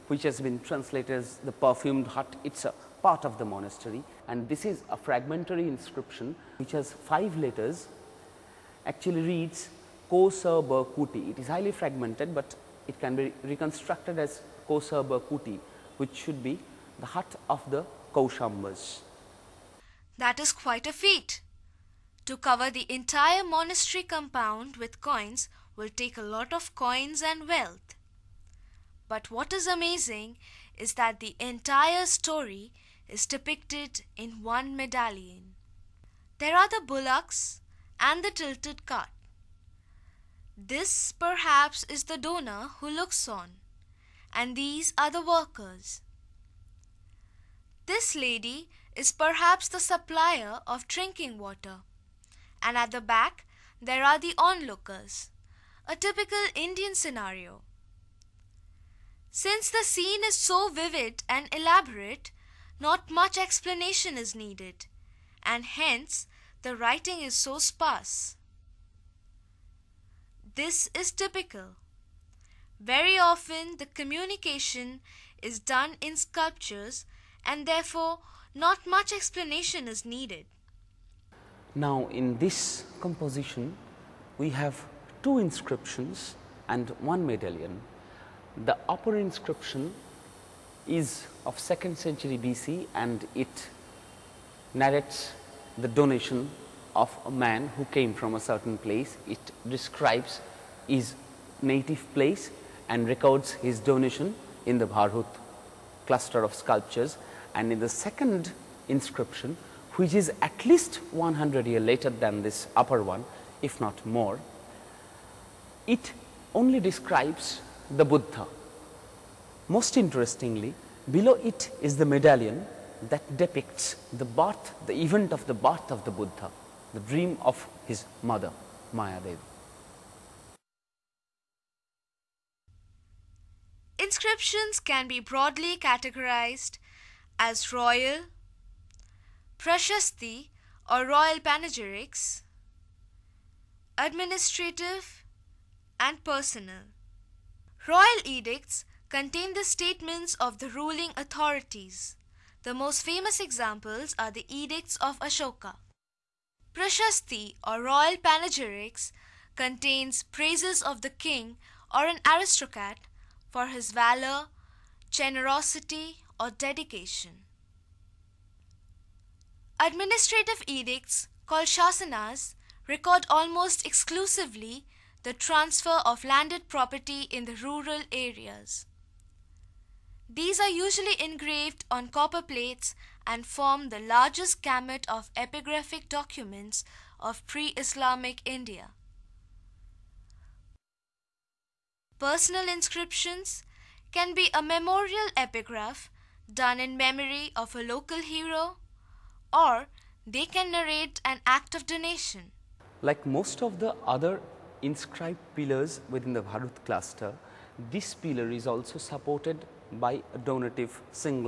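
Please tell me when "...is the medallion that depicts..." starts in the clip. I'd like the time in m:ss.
2:01.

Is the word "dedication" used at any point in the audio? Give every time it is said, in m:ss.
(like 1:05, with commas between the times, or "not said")
2:46.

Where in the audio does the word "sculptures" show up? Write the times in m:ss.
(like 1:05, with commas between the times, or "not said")
1:16, 1:46.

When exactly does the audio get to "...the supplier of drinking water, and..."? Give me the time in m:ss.
0:49.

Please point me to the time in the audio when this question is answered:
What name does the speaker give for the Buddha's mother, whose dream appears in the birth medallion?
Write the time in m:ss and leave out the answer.
2:08.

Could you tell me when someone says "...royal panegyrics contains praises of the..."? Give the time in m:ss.
2:37.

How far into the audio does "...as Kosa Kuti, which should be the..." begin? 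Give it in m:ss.
0:14.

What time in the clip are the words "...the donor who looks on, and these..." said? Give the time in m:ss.
0:42.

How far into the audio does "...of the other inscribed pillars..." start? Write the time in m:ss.
3:23.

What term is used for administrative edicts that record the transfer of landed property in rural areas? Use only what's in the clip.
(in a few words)
Shasanas.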